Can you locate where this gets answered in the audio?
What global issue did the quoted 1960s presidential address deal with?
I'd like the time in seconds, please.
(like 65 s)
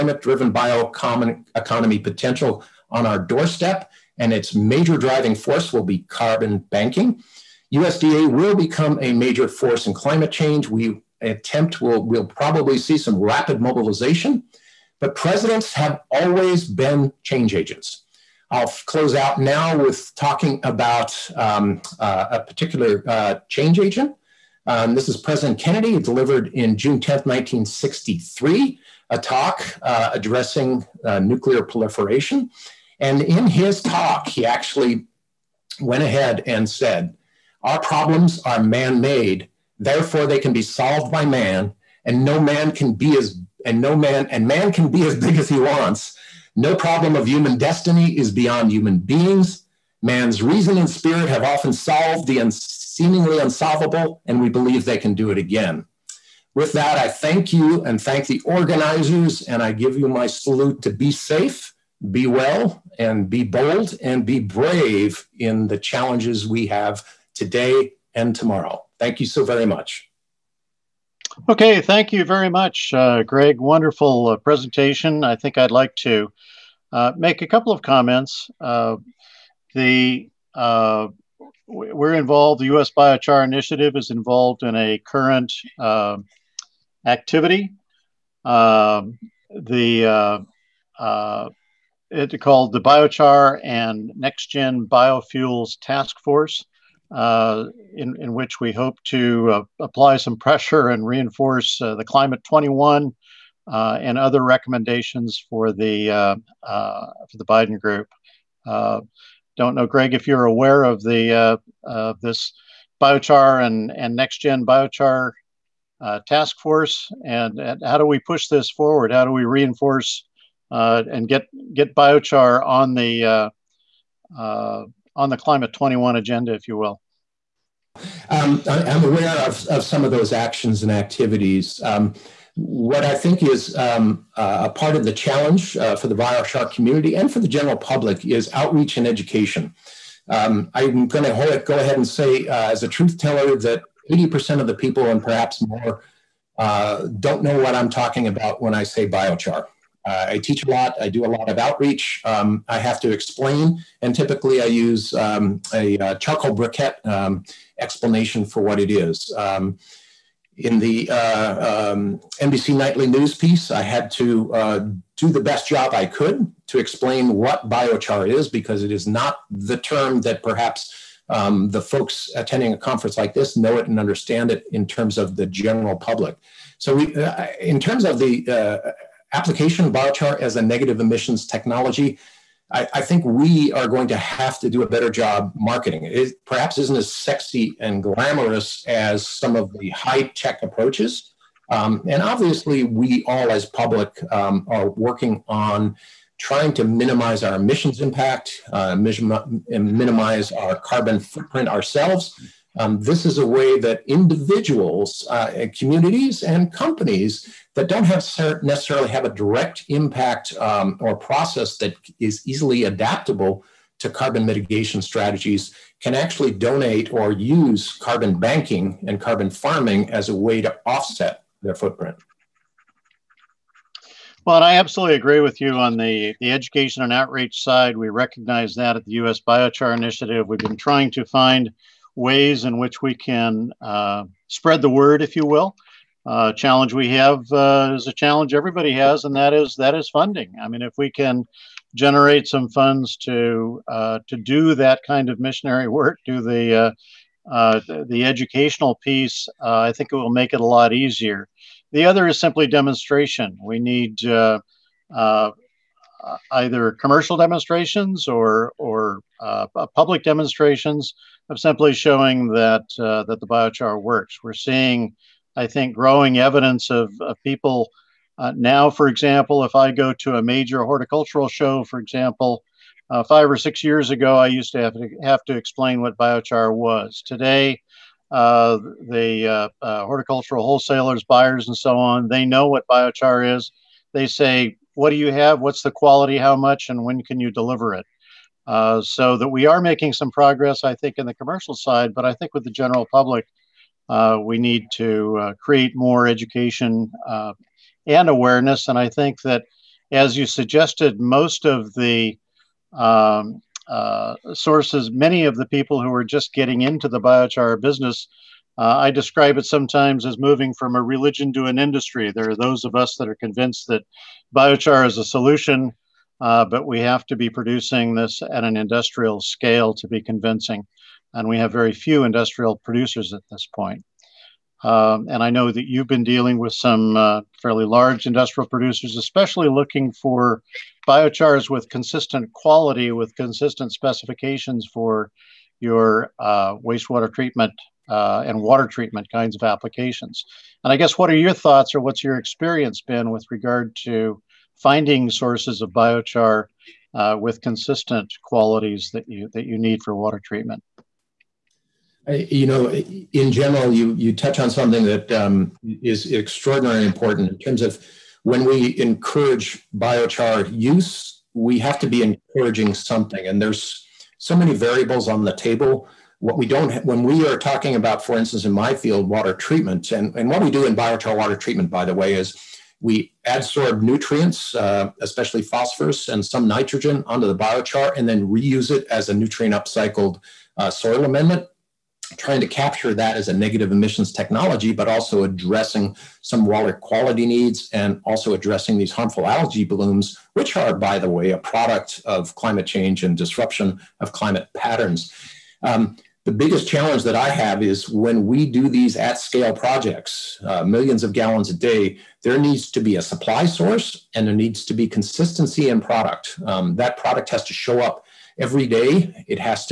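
31 s.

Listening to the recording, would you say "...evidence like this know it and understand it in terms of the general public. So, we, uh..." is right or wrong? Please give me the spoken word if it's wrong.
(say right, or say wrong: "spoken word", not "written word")
wrong: "conference", not "evidence".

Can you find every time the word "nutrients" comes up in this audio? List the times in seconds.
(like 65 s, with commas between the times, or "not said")
374 s, 379 s.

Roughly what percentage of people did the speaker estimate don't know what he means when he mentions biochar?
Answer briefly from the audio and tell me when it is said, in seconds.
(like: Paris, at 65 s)
80%, at 144 s.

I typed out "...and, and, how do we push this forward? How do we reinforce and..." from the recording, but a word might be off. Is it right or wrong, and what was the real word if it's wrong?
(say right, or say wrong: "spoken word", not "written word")
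right.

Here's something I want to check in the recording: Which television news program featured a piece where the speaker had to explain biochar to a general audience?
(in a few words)
NBC Nightly News.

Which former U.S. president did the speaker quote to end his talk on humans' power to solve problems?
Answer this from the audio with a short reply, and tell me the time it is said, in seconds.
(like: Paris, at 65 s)
President Kennedy, at 25 s.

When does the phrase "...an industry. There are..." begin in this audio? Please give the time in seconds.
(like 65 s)
311 s.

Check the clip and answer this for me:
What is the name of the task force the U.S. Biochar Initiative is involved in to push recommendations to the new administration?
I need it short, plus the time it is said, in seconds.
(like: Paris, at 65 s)
Biochar and Next Gen Biofuels Task Force, at 92 s.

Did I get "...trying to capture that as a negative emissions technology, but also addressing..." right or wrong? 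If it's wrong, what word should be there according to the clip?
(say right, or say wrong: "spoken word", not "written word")
right.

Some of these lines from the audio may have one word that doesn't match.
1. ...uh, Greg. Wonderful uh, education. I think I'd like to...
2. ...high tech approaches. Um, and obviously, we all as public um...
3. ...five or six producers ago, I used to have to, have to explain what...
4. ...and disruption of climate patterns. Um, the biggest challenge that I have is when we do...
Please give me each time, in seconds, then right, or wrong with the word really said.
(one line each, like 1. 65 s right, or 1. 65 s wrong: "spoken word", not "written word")
1. 72 s wrong: "presentation", not "education"
2. 189 s right
3. 273 s wrong: "years", not "producers"
4. 393 s right.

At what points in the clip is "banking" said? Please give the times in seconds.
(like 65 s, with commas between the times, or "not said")
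6 s, 218 s.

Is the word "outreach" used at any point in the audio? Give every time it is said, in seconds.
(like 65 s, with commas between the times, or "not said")
138 s, 151 s, 227 s.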